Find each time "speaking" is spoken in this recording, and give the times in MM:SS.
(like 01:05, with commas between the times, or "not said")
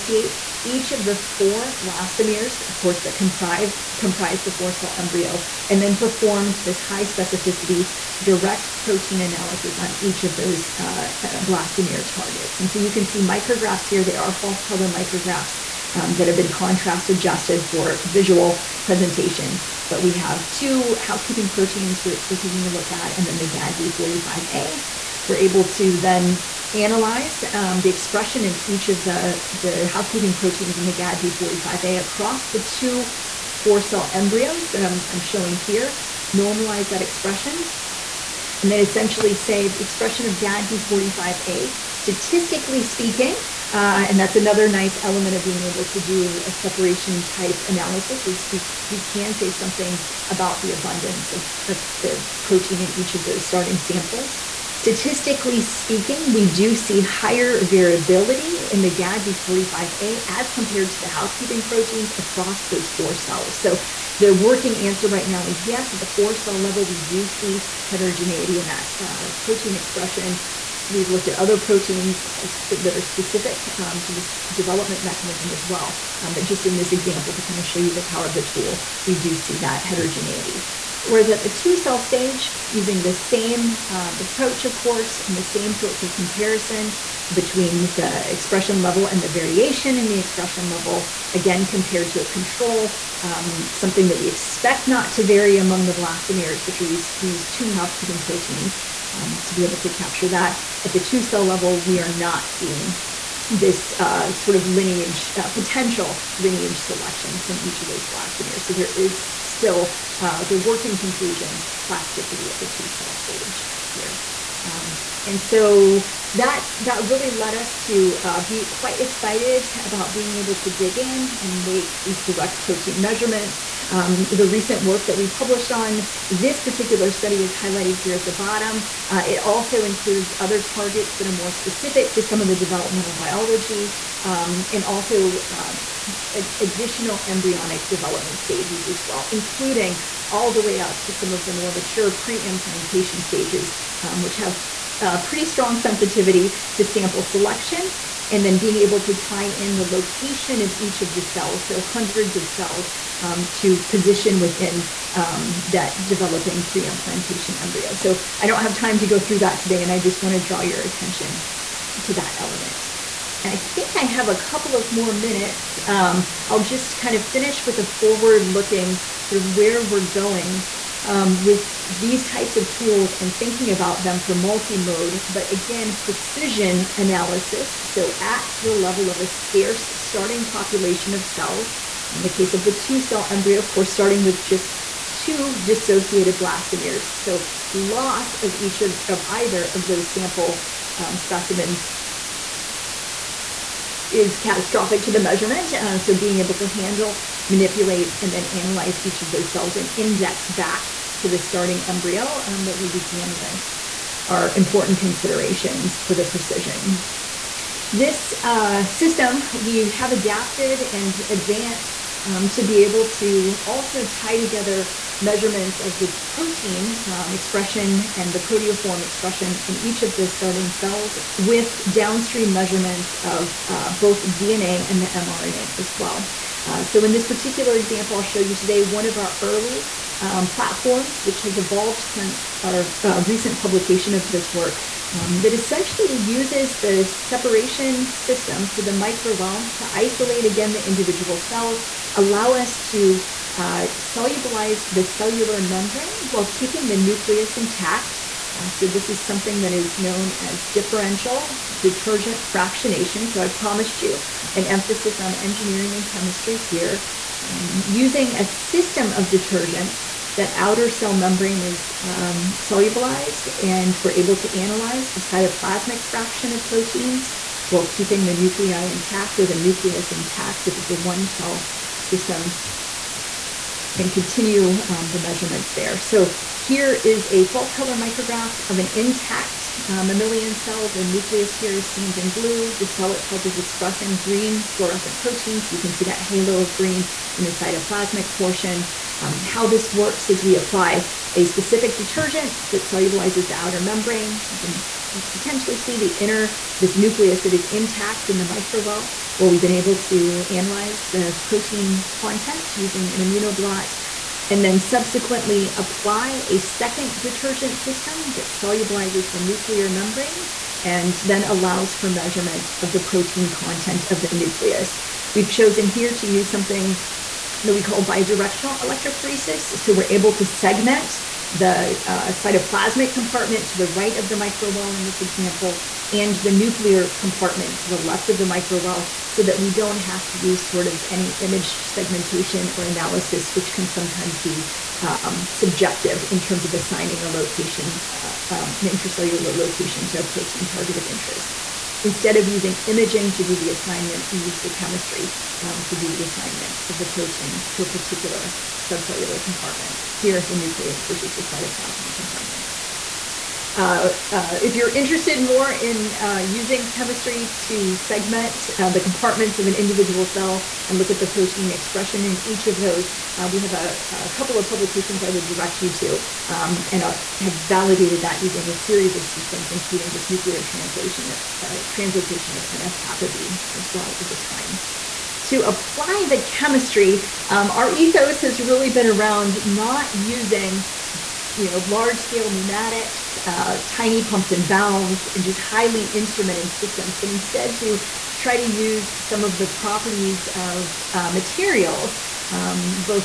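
00:42, 00:55.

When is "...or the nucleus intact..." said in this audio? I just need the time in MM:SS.
04:29.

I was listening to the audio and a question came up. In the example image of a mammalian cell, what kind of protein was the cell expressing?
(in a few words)
green fluorescent proteins.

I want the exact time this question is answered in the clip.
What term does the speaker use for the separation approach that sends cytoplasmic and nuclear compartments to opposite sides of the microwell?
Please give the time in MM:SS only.
05:18.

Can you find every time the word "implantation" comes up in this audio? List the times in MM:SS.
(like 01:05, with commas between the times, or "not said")
02:22, 02:36.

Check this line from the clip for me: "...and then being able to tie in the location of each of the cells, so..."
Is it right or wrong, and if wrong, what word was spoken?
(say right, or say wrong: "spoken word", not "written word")
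right.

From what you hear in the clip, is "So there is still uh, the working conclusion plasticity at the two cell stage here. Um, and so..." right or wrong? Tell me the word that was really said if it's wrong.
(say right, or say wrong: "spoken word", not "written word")
right.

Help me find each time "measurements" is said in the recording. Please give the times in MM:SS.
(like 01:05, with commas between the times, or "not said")
02:03, 03:15, 03:35, 03:42, 04:35, 05:12.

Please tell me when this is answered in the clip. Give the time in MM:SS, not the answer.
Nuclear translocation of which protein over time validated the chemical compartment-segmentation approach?
06:12.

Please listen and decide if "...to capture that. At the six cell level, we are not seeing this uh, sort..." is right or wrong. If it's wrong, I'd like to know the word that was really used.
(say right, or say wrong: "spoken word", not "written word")
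wrong: "two", not "six".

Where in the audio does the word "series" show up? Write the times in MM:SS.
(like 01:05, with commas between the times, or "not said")
06:08.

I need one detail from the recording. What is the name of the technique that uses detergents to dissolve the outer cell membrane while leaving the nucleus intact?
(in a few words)
differential detergent fractionation.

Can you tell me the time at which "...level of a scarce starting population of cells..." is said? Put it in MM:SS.
02:58.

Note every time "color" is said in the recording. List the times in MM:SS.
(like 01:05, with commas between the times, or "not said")
00:14, 04:37.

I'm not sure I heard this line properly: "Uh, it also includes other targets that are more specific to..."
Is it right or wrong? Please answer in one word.
right.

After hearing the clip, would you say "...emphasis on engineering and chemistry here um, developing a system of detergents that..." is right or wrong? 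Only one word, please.
wrong.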